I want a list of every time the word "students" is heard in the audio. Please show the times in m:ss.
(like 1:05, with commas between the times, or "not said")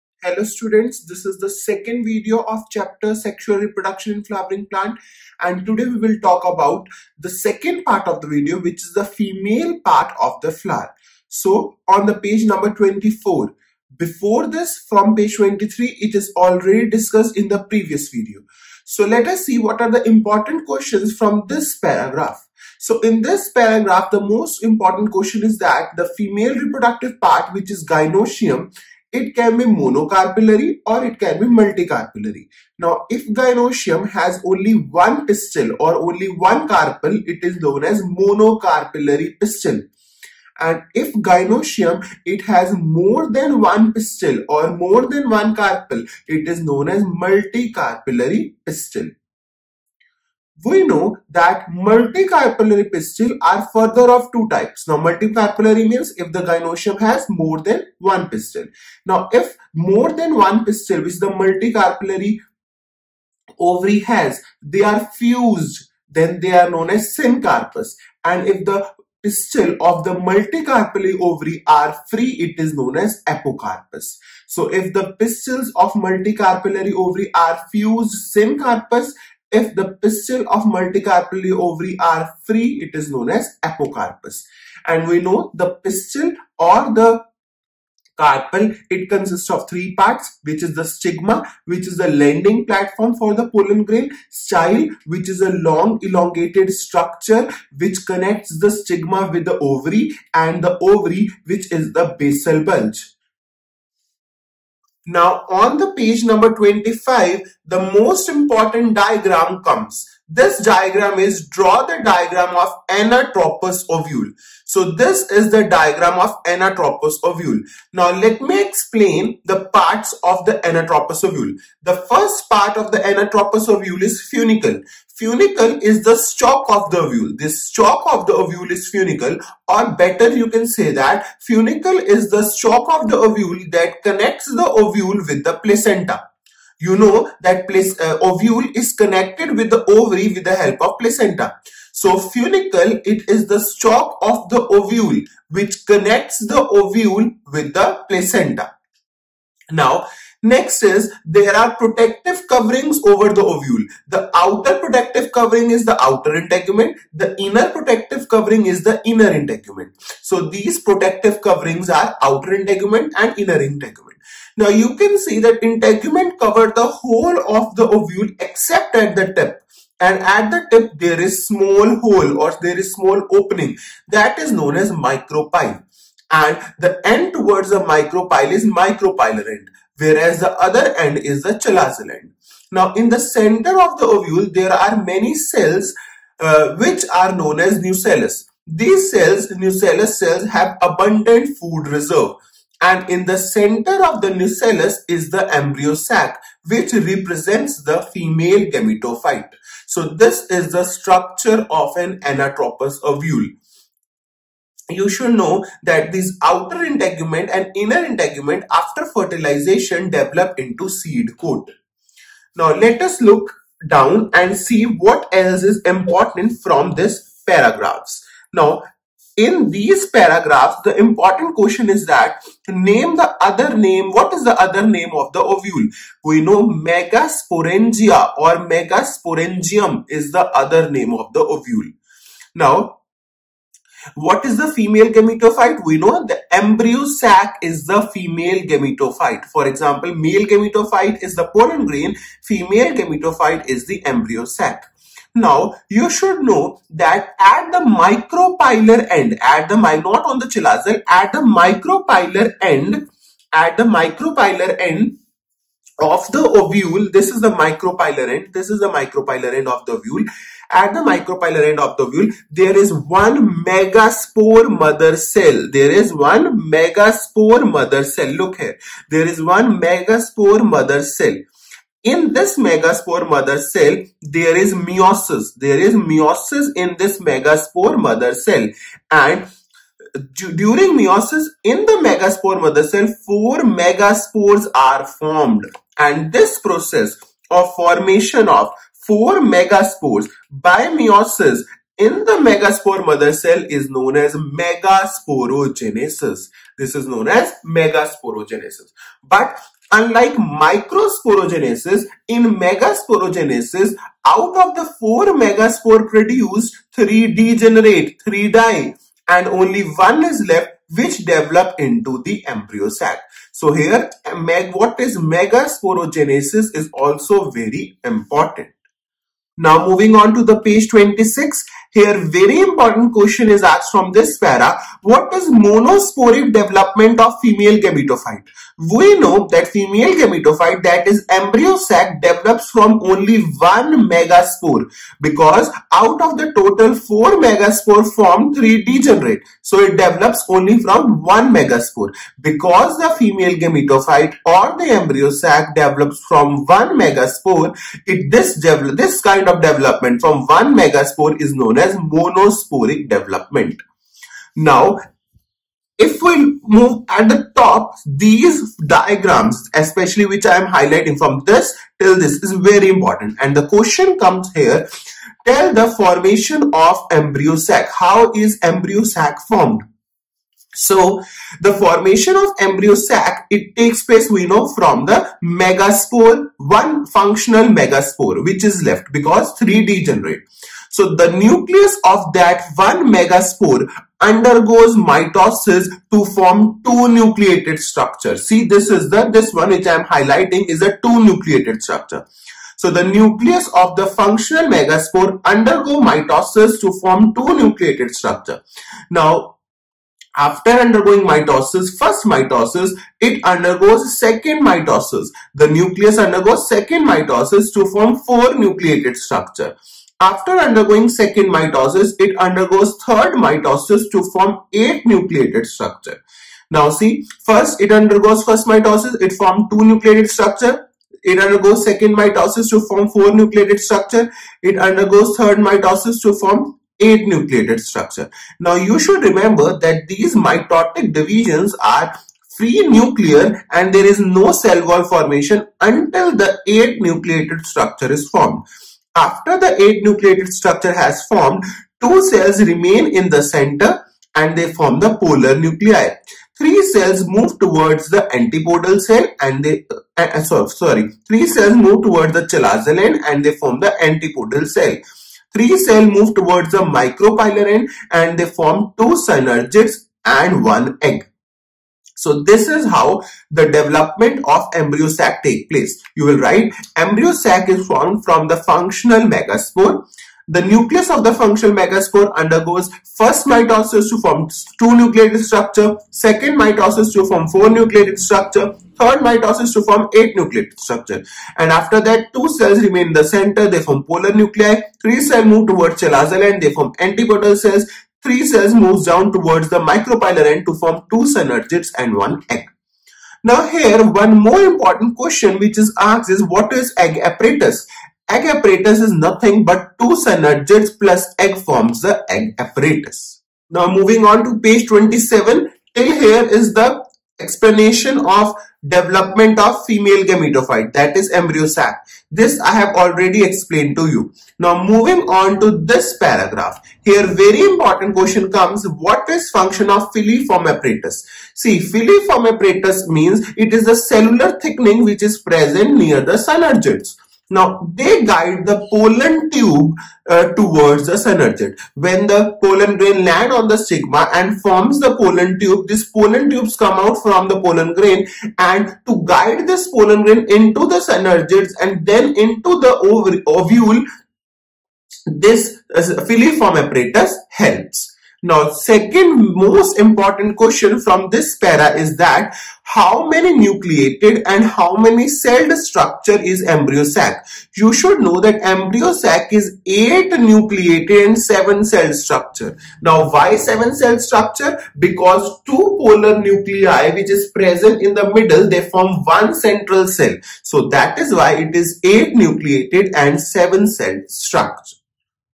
0:00.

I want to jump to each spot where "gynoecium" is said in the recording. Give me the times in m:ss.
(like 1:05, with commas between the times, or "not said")
0:27, 0:33, 0:41, 0:56.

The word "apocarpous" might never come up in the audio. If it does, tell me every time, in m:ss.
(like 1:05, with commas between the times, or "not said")
1:13, 1:23.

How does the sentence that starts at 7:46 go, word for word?
You will write embryo sac is formed from the functional megaspore.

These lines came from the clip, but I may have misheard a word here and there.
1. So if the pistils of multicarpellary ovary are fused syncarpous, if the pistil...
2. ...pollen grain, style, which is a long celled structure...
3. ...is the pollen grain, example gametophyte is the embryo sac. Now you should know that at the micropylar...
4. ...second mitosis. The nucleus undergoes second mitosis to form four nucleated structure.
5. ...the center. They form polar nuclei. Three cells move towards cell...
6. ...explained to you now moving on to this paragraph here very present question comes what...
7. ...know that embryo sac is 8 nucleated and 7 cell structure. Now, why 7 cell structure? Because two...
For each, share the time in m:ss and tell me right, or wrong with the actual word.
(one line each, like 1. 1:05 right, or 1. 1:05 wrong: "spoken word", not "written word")
1. 1:14 right
2. 1:33 wrong: "elongated", not "celled"
3. 4:01 wrong: "female", not "example"
4. 6:44 right
5. 8:03 right
6. 8:33 wrong: "important", not "present"
7. 9:18 right.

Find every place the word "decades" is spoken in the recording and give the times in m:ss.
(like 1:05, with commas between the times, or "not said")
not said.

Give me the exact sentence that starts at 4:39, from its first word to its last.
And during meiosis in the megaspore mother cell, four megaspores are formed.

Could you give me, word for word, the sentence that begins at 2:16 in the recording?
You know that place, uh, ovule is connected with the ovary with the help of placenta.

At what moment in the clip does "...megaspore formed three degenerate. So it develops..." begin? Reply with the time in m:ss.
5:37.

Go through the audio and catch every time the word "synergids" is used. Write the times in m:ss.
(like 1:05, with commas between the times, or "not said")
7:39, 8:11, 8:20, 8:46, 8:51, 9:00.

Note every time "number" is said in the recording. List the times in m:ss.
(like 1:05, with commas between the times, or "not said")
0:12, 1:46.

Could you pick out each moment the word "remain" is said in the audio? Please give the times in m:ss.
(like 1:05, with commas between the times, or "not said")
7:22, 8:02.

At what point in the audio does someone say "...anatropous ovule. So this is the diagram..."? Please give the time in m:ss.
1:52.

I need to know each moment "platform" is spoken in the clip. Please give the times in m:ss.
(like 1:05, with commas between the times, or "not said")
1:32.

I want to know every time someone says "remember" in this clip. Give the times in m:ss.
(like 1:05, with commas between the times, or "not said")
7:09.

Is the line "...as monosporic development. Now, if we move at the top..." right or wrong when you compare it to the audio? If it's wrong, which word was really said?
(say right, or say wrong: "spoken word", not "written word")
right.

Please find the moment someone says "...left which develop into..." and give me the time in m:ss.
5:10.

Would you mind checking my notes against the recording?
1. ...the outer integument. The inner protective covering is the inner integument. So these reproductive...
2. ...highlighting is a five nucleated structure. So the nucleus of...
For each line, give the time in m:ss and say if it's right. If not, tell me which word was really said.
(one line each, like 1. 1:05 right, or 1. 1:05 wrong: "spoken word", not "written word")
1. 2:35 wrong: "protective", not "reproductive"
2. 6:30 wrong: "two", not "five".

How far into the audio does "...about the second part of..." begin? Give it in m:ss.
0:06.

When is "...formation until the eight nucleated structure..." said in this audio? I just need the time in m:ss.
7:15.